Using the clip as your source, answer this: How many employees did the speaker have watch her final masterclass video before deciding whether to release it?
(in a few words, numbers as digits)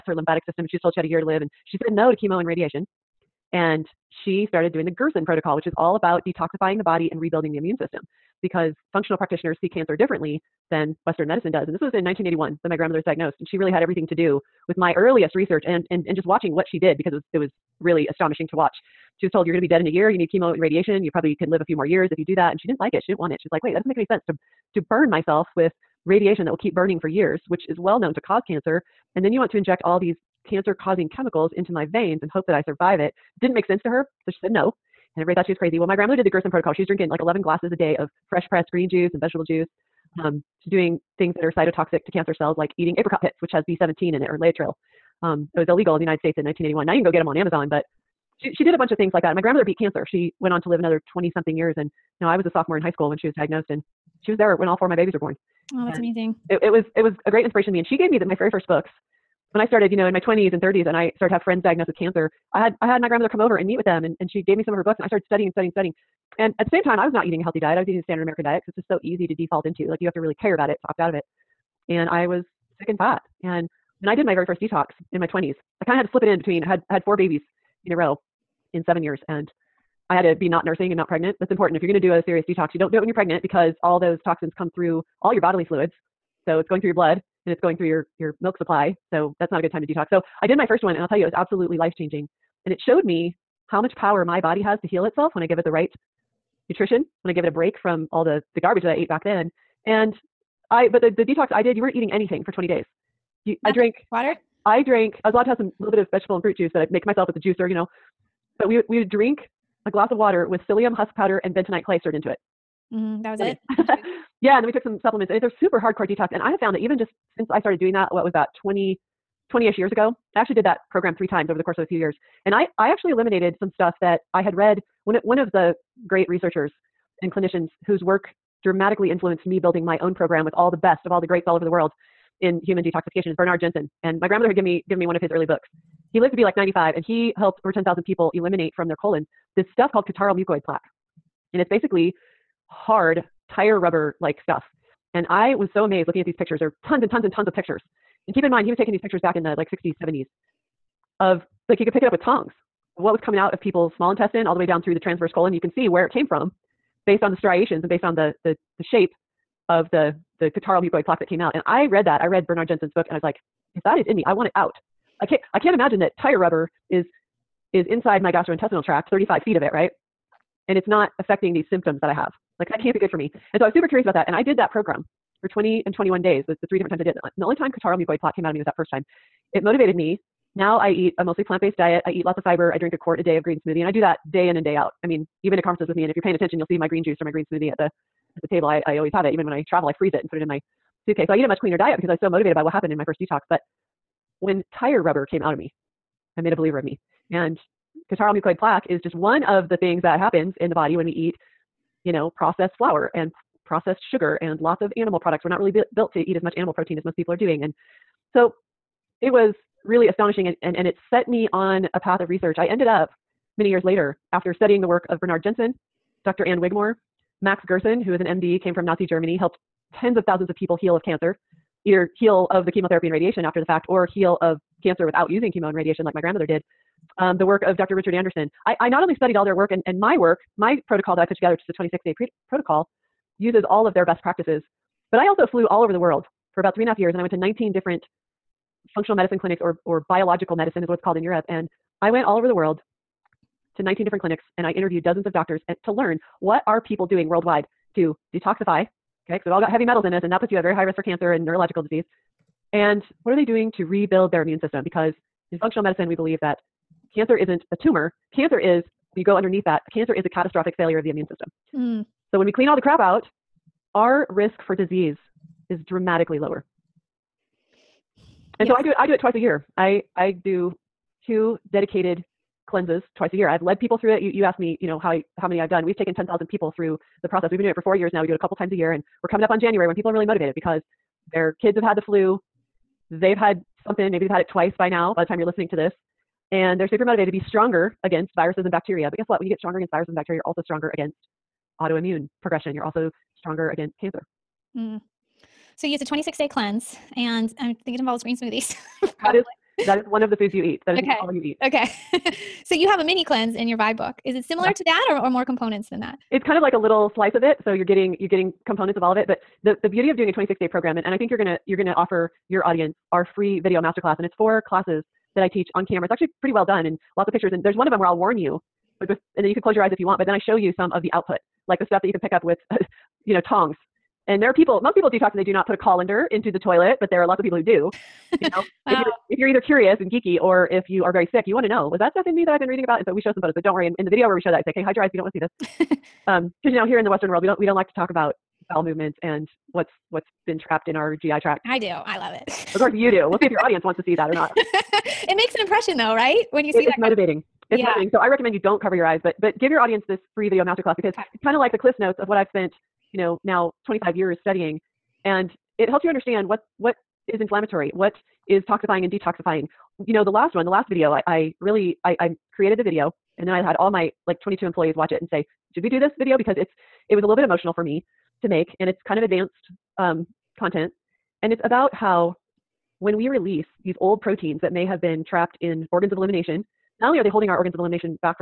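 22.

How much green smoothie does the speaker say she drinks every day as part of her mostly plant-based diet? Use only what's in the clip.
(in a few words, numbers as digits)
a quart.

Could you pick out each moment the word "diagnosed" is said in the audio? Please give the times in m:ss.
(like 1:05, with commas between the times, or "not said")
0:13, 0:53, 1:01.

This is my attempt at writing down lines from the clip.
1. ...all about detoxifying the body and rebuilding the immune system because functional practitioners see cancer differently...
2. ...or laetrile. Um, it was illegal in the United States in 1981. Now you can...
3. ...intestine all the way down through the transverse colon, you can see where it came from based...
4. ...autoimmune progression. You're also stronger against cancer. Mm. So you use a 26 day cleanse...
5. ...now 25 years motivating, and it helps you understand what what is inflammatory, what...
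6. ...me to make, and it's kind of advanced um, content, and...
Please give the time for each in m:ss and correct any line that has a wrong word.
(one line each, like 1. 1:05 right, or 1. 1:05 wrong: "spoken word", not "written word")
1. 0:05 right
2. 0:44 right
3. 2:34 right
4. 4:51 right
5. 5:53 wrong: "studying", not "motivating"
6. 6:07 right.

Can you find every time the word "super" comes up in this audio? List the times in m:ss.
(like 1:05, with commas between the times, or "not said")
1:55, 2:53, 4:46.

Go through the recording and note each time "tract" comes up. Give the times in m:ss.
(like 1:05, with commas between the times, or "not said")
2:48, 5:41.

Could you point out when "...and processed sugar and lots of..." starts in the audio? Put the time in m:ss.
3:23.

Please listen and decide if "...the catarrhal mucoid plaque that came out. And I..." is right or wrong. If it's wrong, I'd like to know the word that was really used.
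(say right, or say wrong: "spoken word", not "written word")
right.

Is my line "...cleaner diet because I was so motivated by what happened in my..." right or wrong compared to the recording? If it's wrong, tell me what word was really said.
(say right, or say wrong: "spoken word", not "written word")
right.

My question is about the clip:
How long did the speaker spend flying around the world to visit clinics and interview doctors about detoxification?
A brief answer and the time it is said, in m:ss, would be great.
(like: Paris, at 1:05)
three and a half years, at 3:56.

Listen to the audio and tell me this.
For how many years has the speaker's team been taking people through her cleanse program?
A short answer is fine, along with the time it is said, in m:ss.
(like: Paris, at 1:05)
4, at 4:37.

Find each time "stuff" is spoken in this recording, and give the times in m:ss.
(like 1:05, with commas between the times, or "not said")
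2:03, 2:19, 2:24, 5:21, 5:32.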